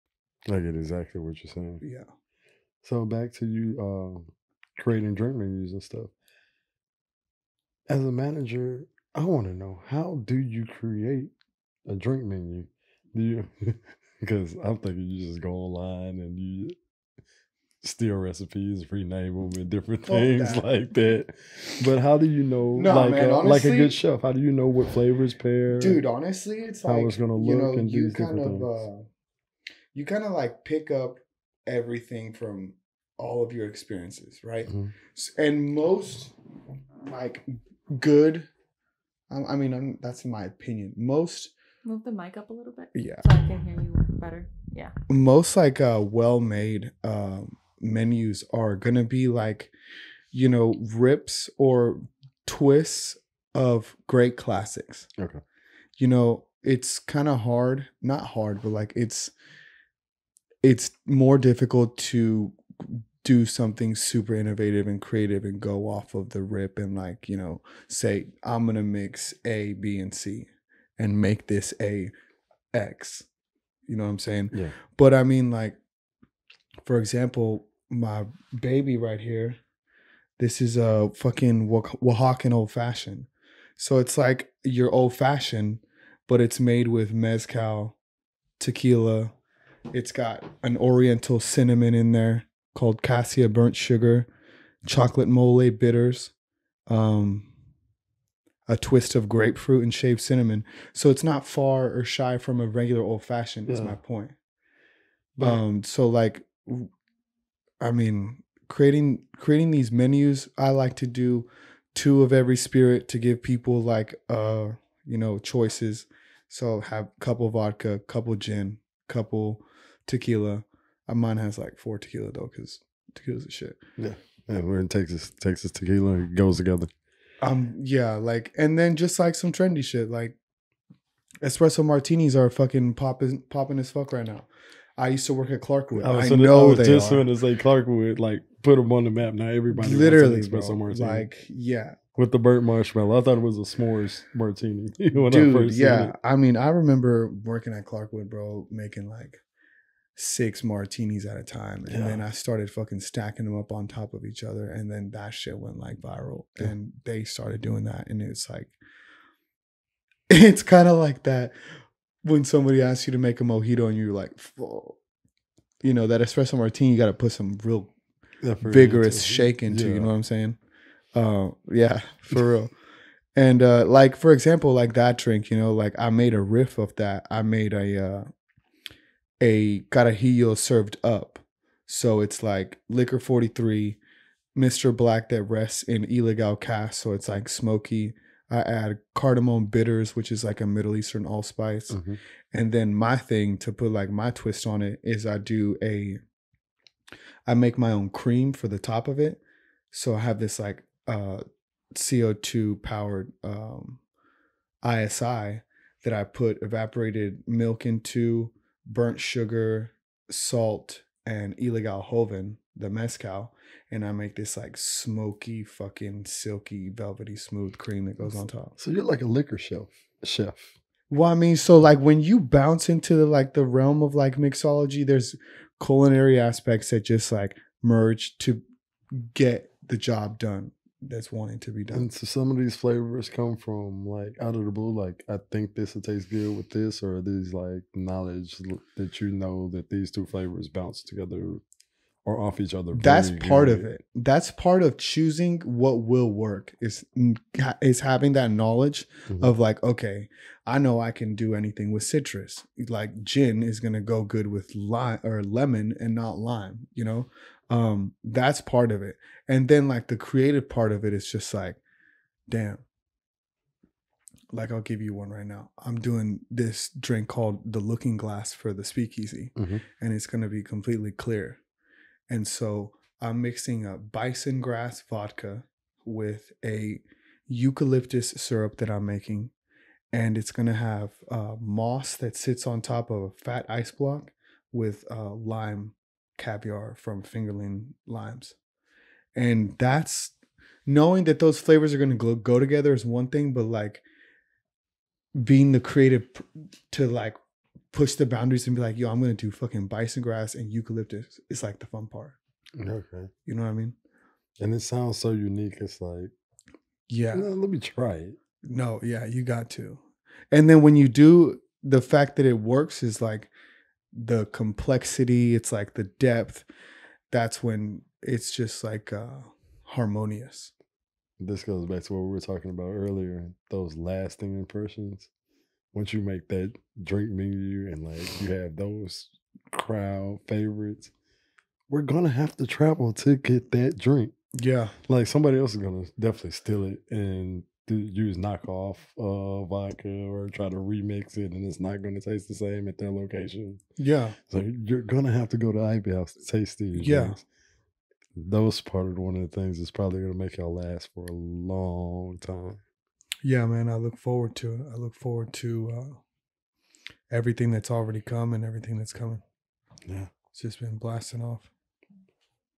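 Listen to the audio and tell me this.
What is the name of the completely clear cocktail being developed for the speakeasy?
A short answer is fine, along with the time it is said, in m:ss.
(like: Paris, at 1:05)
The Looking Glass, at 4:27.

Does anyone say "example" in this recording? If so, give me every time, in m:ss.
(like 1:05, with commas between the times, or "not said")
1:16, 2:54.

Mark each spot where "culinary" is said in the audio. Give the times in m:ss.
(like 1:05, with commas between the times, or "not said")
3:45.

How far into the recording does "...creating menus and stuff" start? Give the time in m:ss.
0:04.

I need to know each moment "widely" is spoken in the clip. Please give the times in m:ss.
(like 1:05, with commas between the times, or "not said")
not said.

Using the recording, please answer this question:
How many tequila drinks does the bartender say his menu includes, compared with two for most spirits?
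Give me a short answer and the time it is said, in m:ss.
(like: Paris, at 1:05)
4, at 2:01.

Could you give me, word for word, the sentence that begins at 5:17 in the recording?
That's when it's just like uh, harmonious.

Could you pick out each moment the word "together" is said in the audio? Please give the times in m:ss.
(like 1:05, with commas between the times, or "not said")
2:06, 4:01, 4:52.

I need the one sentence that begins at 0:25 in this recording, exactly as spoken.
Dude, honestly, it's how like, it's gonna look you know, and you do kind different of, things.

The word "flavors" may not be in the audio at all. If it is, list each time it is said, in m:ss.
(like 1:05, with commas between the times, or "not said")
0:24, 3:52, 4:00, 4:51.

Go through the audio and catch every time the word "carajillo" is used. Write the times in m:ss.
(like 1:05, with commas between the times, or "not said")
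2:59.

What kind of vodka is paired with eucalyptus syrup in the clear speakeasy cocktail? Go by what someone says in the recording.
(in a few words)
Bison grass vodka.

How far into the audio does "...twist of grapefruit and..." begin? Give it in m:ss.
1:38.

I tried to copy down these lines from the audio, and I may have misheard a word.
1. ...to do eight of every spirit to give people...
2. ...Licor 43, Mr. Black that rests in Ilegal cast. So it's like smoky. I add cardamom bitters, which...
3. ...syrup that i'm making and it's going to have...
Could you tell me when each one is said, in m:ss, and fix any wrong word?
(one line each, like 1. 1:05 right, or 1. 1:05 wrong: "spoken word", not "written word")
1. 1:50 wrong: "two", not "eight"
2. 3:02 right
3. 4:38 right.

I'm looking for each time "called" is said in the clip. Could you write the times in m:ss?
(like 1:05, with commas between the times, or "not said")
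1:32, 4:27.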